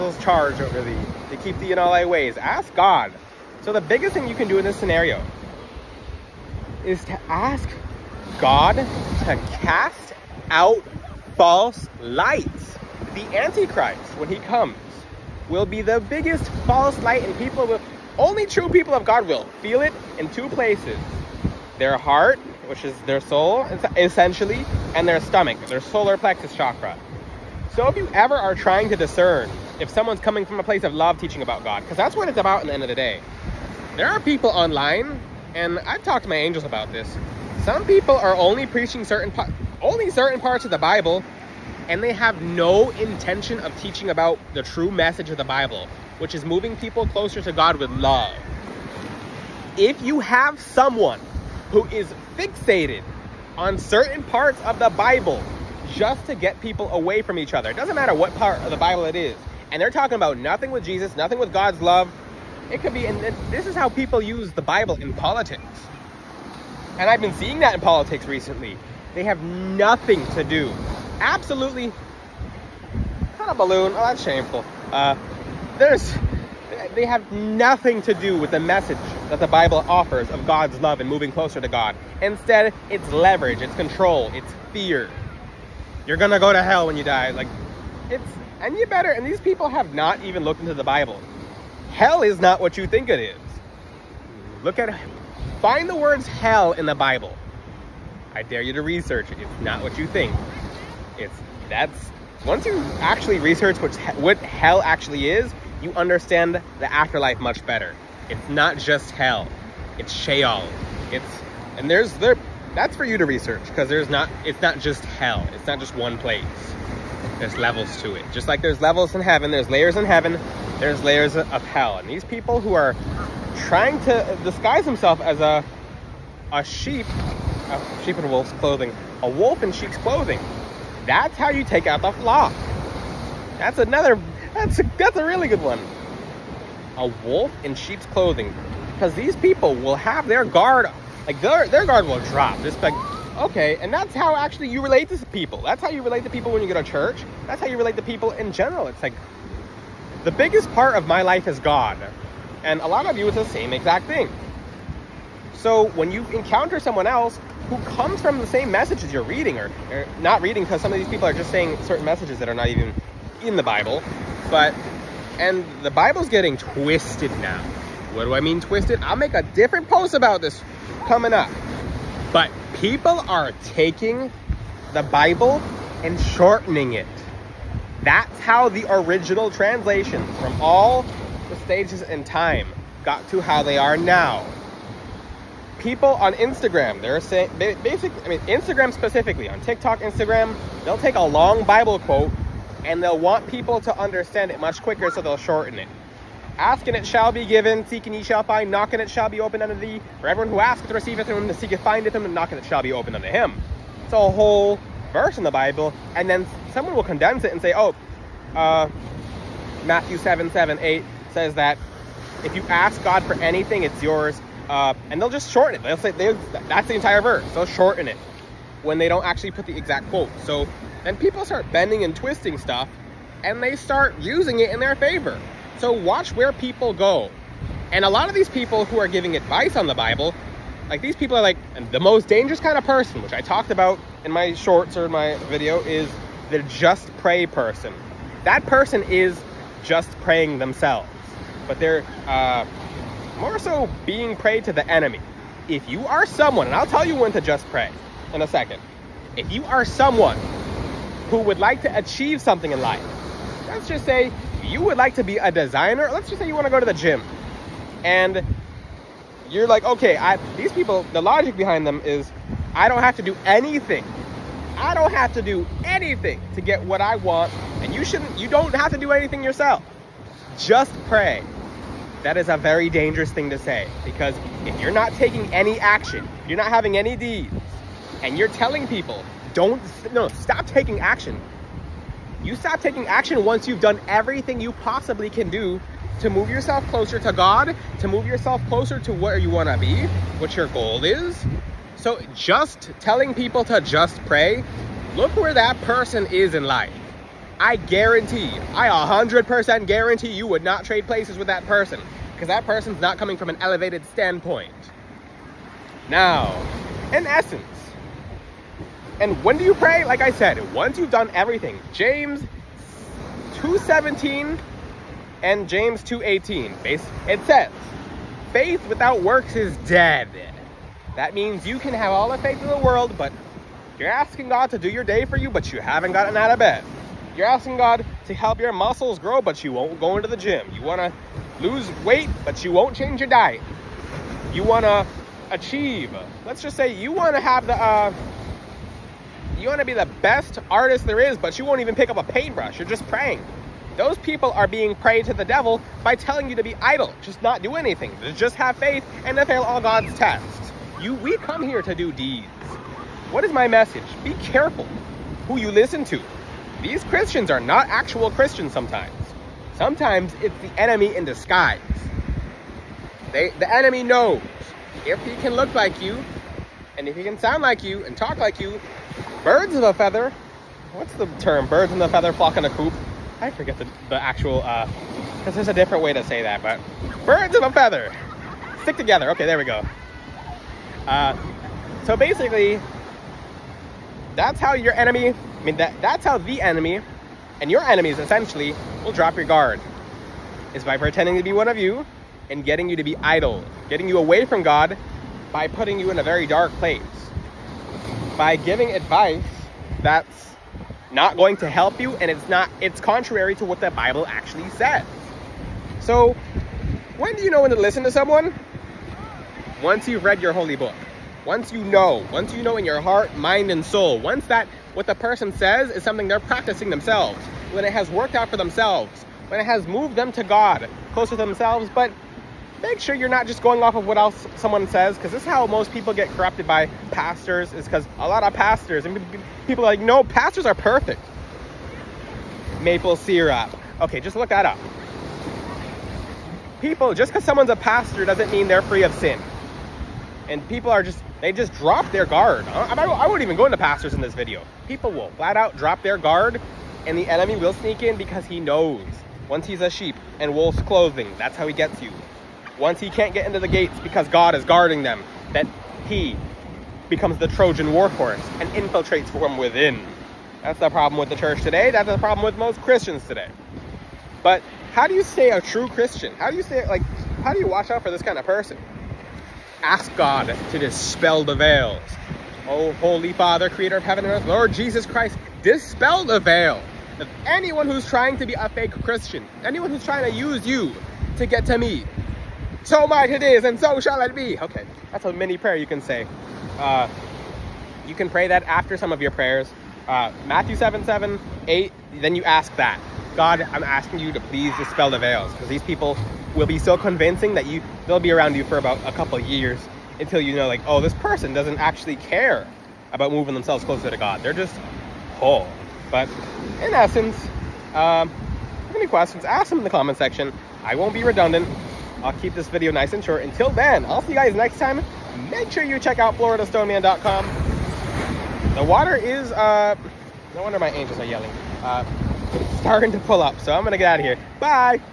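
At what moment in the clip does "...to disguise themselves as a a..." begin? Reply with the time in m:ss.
2:04.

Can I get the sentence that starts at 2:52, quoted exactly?
But people are taking the Bible and shortening it.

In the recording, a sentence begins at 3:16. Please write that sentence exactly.
Asking it shall be given, seeking ye shall find, knocking it shall be opened unto thee.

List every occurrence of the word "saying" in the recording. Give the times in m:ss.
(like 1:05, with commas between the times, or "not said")
2:41, 3:07.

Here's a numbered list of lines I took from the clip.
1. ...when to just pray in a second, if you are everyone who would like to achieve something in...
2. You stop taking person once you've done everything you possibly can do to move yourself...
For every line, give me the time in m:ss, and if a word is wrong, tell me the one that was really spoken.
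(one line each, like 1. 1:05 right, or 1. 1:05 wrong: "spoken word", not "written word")
1. 4:07 wrong: "someone", not "everyone"
2. 4:42 wrong: "action", not "person".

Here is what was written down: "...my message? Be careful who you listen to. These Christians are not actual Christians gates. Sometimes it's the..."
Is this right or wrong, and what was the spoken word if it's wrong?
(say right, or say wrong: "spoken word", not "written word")
wrong: "sometimes", not "gates".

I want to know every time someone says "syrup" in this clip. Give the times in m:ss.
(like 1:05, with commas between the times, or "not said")
7:13.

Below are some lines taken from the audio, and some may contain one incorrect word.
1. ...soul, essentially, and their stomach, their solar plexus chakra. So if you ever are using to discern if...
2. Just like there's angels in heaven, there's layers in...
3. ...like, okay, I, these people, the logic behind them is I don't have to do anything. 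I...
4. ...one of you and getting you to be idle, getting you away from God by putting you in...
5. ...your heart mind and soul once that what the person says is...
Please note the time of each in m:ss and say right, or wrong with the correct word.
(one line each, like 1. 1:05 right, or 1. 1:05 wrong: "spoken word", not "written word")
1. 0:23 wrong: "trying", not "using"
2. 1:58 wrong: "levels", not "angels"
3. 4:19 right
4. 6:31 right
5. 6:52 right.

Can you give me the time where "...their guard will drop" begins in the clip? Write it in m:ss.
2:21.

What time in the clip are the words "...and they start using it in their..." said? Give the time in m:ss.
3:43.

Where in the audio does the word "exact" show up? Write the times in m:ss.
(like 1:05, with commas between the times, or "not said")
2:33, 3:39.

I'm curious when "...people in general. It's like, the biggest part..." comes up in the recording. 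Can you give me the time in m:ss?
2:28.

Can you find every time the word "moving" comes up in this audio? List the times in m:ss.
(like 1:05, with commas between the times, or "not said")
0:46, 1:21, 8:23.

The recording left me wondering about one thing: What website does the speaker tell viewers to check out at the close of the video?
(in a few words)
floridastoneman.com.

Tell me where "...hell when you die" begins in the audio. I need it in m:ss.
1:26.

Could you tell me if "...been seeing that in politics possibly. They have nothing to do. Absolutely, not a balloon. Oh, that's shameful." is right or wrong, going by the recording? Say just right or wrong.
wrong.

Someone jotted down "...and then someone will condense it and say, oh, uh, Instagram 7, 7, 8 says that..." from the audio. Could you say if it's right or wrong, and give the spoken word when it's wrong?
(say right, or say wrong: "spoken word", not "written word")
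wrong: "Matthew", not "Instagram".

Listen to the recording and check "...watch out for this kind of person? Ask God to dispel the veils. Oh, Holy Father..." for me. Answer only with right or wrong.
right.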